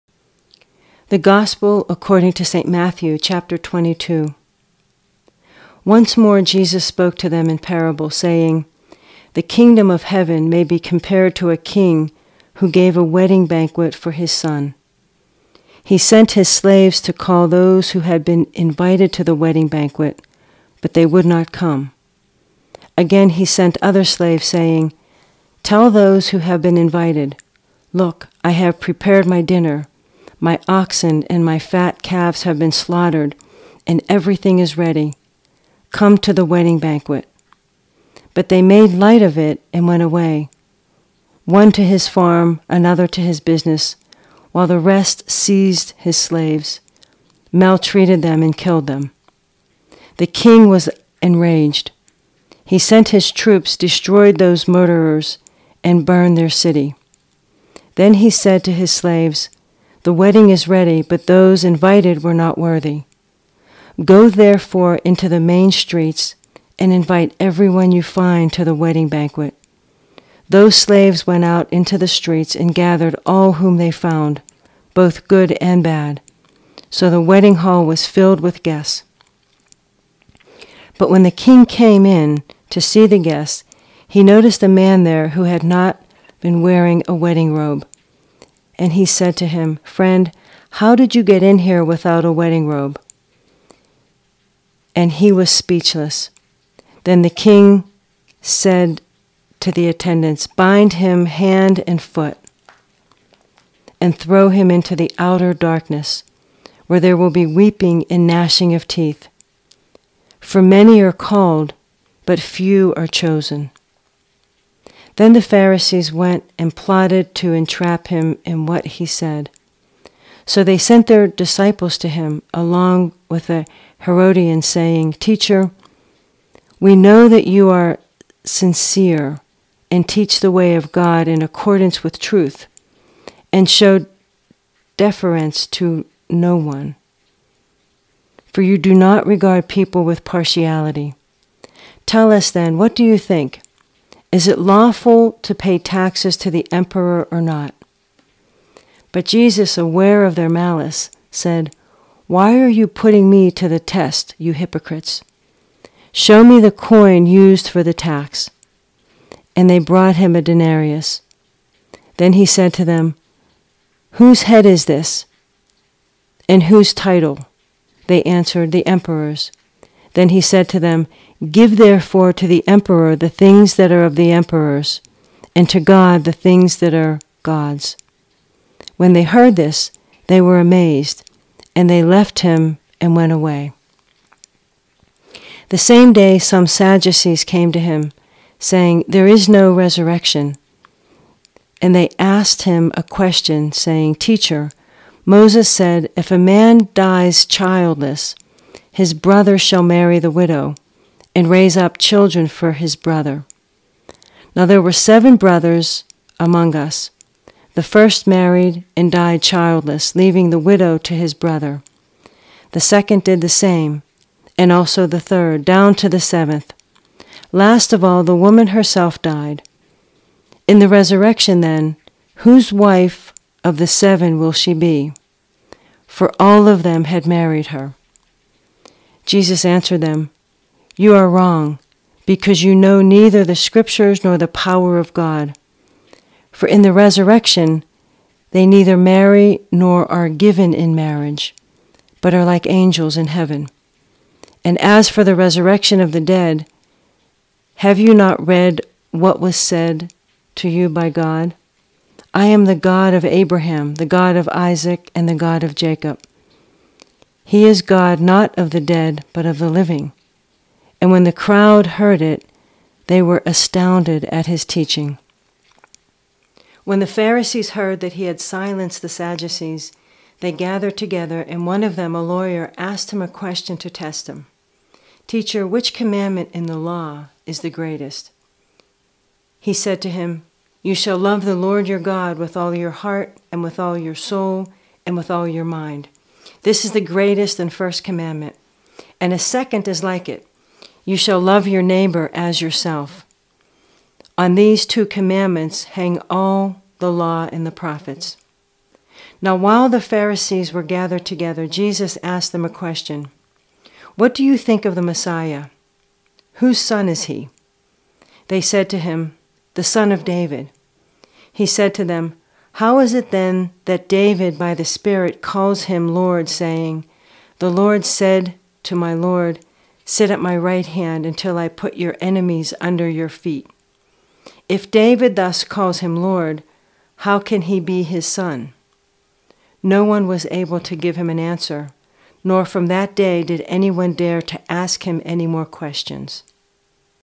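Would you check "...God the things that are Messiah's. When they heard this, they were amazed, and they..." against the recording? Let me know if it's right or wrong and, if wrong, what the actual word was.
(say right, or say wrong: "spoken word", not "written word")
wrong: "God", not "Messiah".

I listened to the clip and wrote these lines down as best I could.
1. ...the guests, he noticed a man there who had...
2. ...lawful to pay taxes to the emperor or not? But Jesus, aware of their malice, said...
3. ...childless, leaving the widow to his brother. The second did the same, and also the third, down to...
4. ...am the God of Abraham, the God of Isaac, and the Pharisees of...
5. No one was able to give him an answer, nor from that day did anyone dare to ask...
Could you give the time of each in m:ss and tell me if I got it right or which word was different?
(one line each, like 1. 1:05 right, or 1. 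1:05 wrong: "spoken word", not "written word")
1. 1:23 right
2. 2:24 right
3. 3:29 right
4. 4:12 wrong: "God", not "Pharisees"
5. 5:29 right.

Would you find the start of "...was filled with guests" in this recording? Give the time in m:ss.
1:17.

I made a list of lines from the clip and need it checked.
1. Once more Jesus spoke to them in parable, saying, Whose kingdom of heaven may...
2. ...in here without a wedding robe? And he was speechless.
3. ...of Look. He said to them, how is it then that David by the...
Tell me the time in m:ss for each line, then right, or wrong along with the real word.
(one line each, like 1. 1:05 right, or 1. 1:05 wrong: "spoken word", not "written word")
1. 0:05 wrong: "The", not "Whose"
2. 1:31 right
3. 5:10 wrong: "David", not "Look".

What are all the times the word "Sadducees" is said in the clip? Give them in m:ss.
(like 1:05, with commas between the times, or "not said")
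3:06, 4:29.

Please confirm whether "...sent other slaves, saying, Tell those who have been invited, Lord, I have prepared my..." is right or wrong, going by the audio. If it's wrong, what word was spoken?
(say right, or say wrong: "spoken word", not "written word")
wrong: "Look", not "Lord".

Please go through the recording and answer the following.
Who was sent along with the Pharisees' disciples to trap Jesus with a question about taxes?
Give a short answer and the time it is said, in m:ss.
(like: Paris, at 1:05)
A Herodian, at 2:03.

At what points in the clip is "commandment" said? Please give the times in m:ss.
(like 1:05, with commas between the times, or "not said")
4:35, 4:48, 4:55.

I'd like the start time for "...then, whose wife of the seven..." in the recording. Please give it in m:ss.
3:41.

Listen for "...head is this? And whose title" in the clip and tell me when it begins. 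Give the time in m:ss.
2:44.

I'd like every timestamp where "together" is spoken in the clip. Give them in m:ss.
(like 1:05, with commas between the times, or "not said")
4:30, 5:01.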